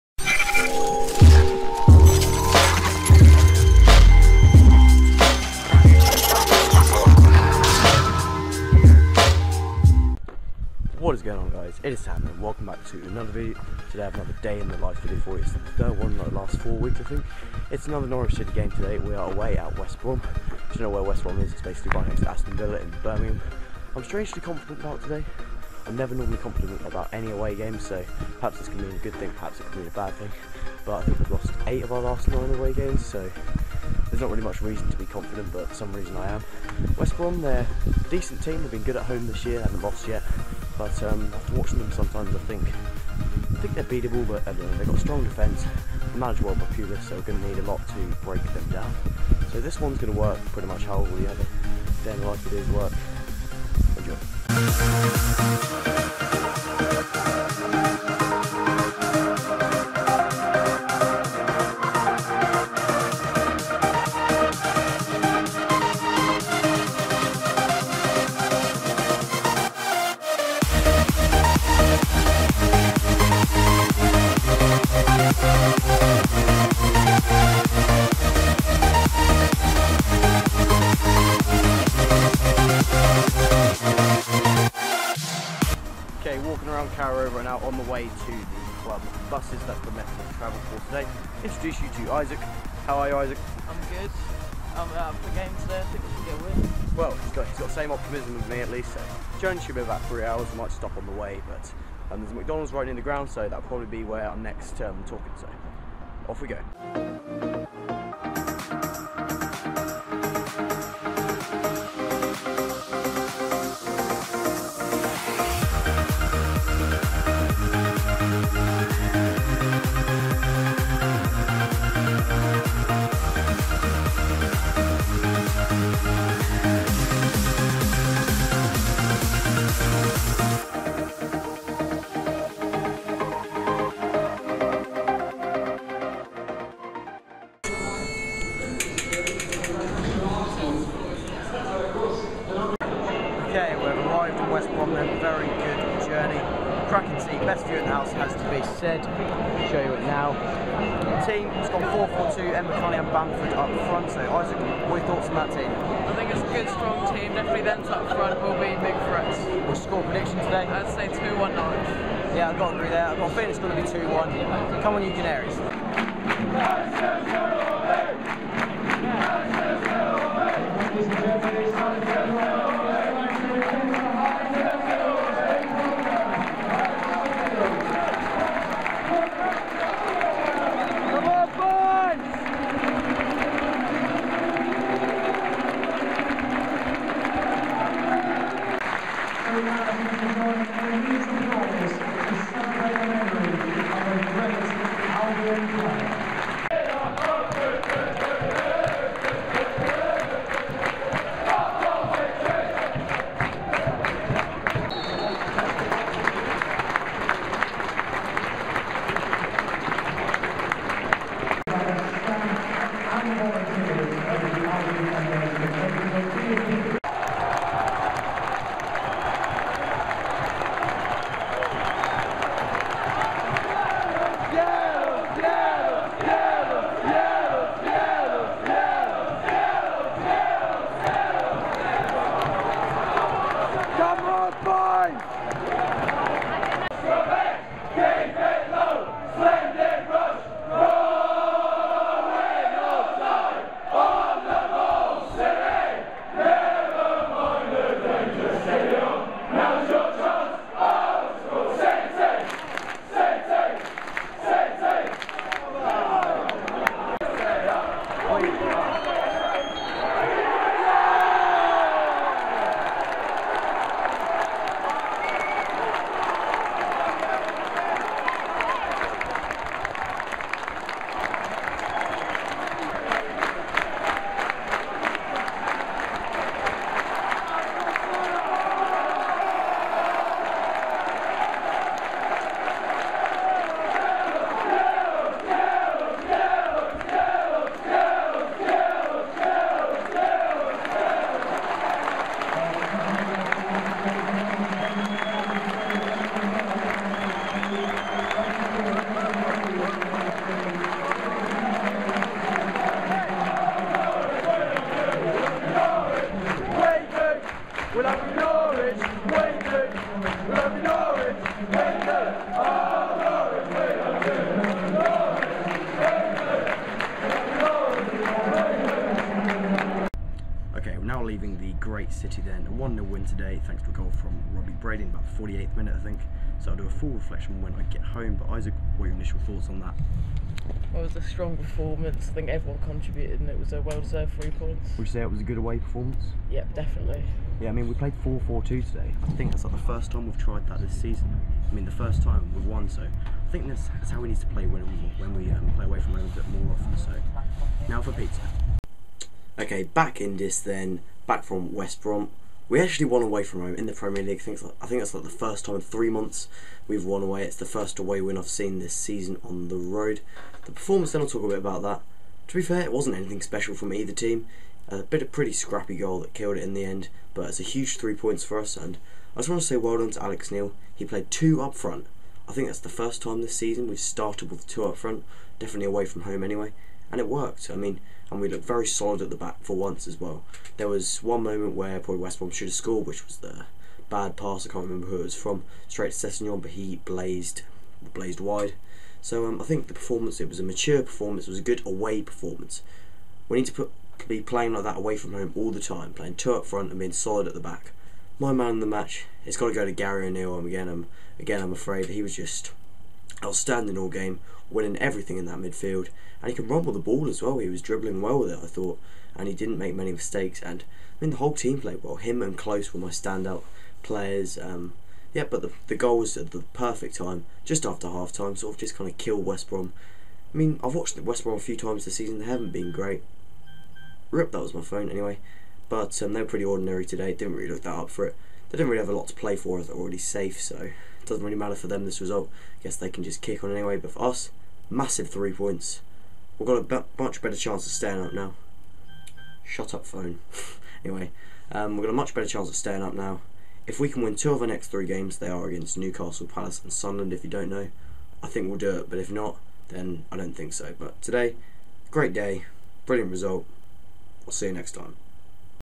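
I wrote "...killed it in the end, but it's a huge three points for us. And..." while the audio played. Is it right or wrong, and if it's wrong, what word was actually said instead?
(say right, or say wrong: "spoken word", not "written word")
right.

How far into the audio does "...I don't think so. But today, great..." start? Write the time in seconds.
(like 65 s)
450 s.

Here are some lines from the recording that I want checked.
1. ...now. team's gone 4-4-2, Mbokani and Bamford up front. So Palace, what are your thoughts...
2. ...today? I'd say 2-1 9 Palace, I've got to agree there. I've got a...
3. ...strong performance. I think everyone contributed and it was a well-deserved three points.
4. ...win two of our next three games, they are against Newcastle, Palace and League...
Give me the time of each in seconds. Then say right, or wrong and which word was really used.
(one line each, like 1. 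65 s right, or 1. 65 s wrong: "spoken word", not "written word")
1. 150 s wrong: "Isaac", not "Palace"
2. 160 s wrong: "Yeah", not "Palace"
3. 331 s right
4. 444 s wrong: "Sunderland", not "League".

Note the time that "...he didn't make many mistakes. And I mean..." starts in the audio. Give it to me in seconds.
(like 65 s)
409 s.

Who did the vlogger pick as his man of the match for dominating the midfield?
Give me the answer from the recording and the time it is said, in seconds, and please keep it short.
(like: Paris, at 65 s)
Gary O'Neill, at 399 s.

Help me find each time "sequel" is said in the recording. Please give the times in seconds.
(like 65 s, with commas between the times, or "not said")
not said.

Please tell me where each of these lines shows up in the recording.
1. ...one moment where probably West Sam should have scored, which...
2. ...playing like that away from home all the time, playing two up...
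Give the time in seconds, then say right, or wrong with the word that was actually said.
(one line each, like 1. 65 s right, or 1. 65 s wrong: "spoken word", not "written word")
1. 381 s wrong: "Brom", not "Sam"
2. 394 s right.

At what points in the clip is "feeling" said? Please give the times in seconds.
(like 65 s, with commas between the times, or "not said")
163 s.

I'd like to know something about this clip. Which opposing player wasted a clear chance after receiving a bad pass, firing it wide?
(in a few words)
Sessegnon.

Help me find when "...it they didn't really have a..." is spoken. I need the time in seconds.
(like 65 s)
428 s.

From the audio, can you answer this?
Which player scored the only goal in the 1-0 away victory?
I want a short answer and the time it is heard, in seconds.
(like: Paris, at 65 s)
Robbie Brady, at 324 s.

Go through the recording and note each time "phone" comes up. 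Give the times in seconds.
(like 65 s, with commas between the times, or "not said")
424 s, 440 s.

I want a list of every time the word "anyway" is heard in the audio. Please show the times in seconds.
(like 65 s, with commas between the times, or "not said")
376 s, 425 s, 433 s, 441 s.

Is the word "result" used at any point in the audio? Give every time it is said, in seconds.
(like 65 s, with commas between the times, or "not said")
432 s, 453 s.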